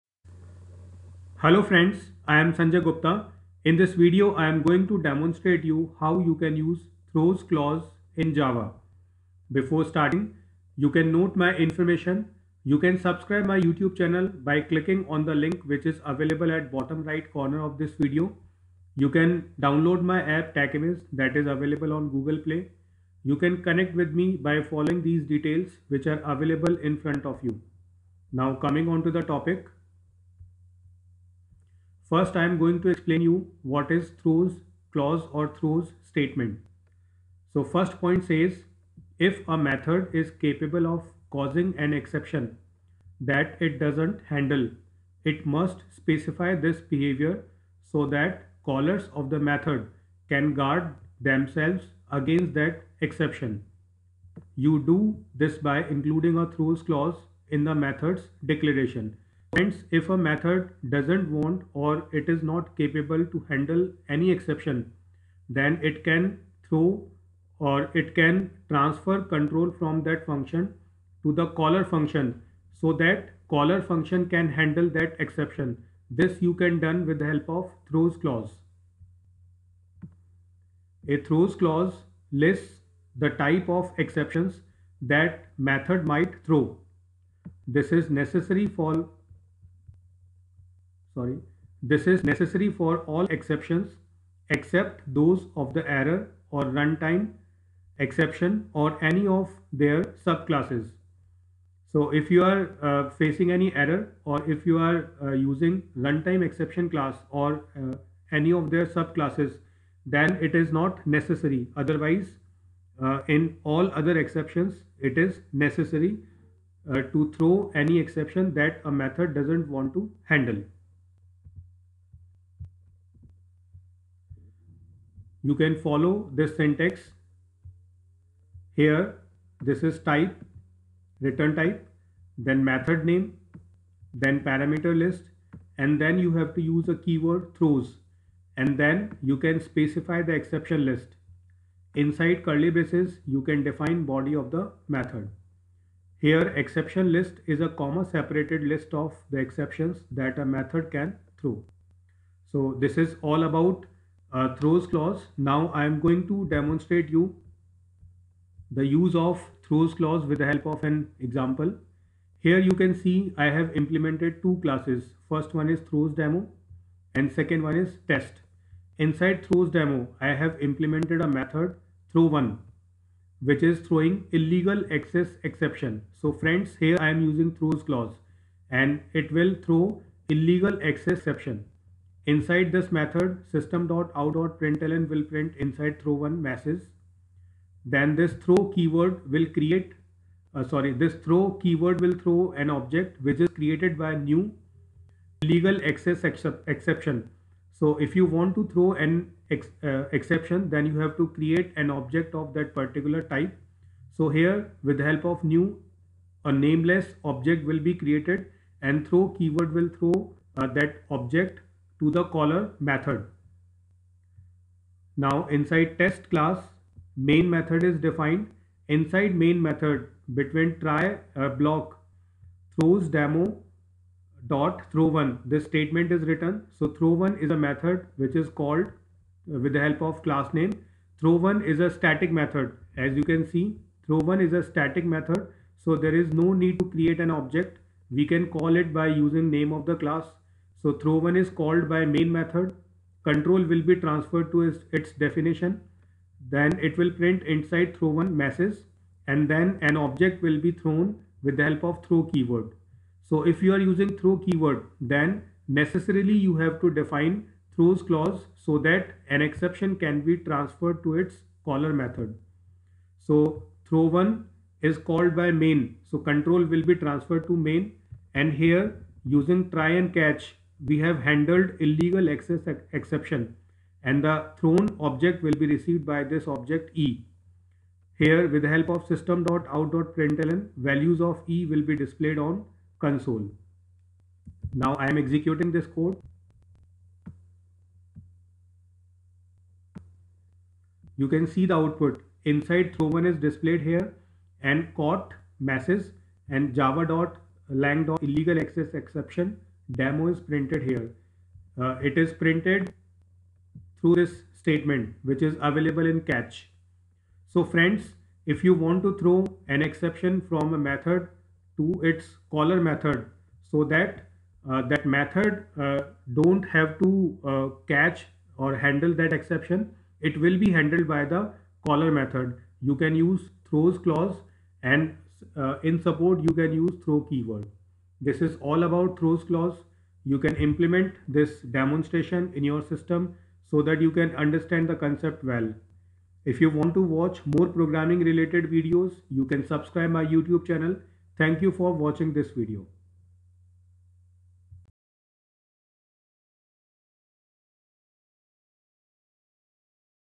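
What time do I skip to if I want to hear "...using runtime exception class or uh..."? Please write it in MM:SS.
01:45.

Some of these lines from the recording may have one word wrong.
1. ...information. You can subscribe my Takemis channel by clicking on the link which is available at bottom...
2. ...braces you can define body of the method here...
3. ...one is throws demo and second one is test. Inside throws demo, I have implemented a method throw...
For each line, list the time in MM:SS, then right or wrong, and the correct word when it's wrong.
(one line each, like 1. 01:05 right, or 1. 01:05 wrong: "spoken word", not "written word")
1. 00:11 wrong: "YouTube", not "Takemis"
2. 02:22 right
3. 02:45 right.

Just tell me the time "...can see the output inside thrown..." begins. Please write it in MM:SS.
04:51.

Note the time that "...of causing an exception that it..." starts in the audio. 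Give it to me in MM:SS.
00:40.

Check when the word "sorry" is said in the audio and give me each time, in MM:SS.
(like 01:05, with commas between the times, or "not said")
01:31, 03:10.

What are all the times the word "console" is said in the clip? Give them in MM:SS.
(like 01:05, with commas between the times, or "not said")
04:42.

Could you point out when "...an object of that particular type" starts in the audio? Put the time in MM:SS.
03:21.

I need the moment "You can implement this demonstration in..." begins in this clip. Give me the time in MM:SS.
05:30.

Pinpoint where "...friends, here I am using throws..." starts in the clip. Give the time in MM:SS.
02:56.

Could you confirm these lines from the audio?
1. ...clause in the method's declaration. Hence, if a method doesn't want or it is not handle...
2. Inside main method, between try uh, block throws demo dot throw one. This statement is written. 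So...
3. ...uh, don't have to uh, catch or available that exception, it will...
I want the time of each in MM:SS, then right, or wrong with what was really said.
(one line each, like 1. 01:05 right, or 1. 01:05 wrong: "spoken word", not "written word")
1. 00:56 wrong: "capable", not "handle"
2. 03:38 right
3. 05:15 wrong: "handle", not "available".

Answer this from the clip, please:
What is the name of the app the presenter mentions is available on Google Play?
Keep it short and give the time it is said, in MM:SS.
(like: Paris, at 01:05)
Takemis, at 00:20.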